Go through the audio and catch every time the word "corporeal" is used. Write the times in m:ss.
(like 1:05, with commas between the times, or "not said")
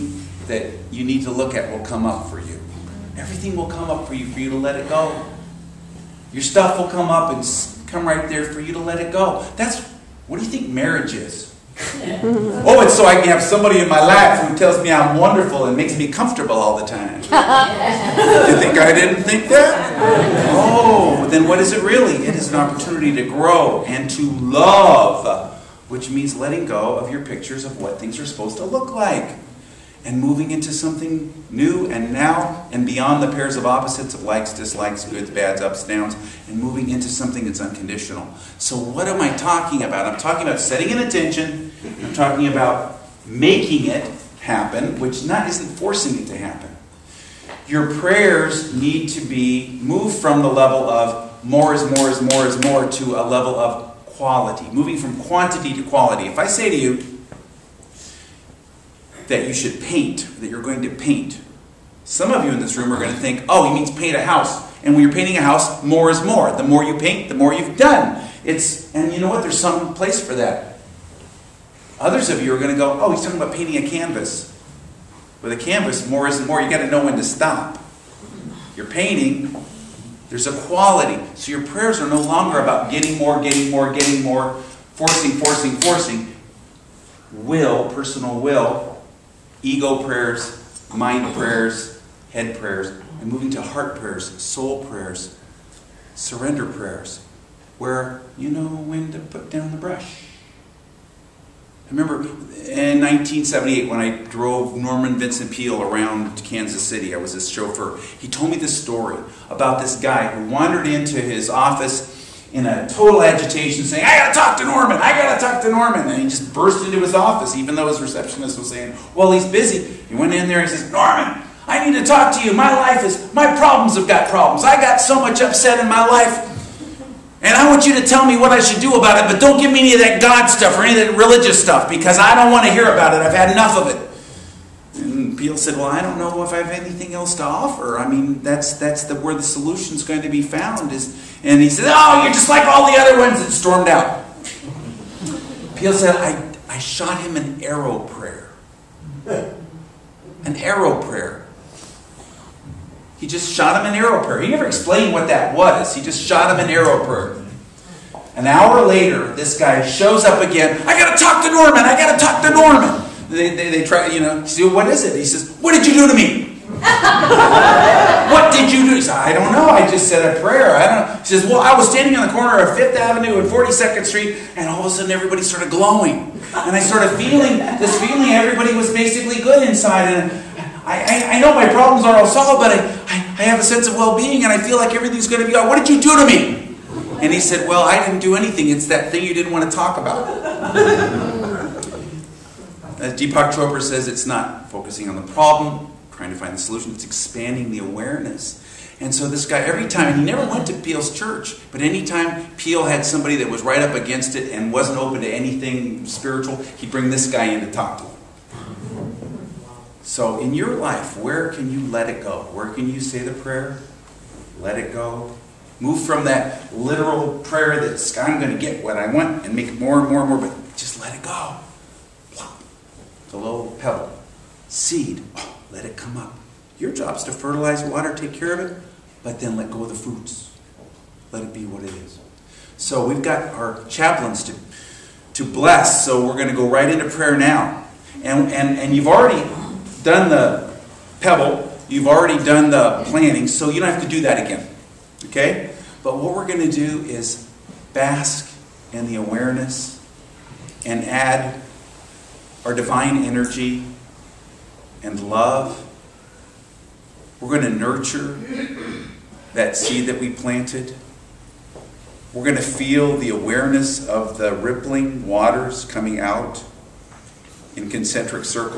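not said.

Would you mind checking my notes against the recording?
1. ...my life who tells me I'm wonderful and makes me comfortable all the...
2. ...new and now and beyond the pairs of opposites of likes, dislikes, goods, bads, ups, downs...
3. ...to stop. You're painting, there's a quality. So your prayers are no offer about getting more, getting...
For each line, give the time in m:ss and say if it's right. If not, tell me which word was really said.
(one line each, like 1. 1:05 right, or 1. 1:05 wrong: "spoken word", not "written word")
1. 0:13 right
2. 0:31 right
3. 1:17 wrong: "longer", not "offer".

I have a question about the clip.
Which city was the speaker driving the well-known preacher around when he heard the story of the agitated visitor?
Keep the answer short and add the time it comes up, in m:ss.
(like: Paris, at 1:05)
Kansas City, at 1:46.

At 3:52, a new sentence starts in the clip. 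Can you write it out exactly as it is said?
So we've got our chaplains to, to bless, so we're going to go right into prayer now.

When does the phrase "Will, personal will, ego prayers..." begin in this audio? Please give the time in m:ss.
1:27.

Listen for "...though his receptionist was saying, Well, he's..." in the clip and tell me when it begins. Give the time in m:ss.
1:57.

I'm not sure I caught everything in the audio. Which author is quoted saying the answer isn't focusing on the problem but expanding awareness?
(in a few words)
Deepak Chopra.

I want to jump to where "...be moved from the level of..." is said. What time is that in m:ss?
0:49.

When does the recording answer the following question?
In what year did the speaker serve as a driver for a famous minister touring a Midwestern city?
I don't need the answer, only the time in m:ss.
1:43.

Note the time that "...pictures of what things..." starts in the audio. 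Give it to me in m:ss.
0:27.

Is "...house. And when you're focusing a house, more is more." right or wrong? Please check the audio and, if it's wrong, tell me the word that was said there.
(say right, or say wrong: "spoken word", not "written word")
wrong: "painting", not "focusing".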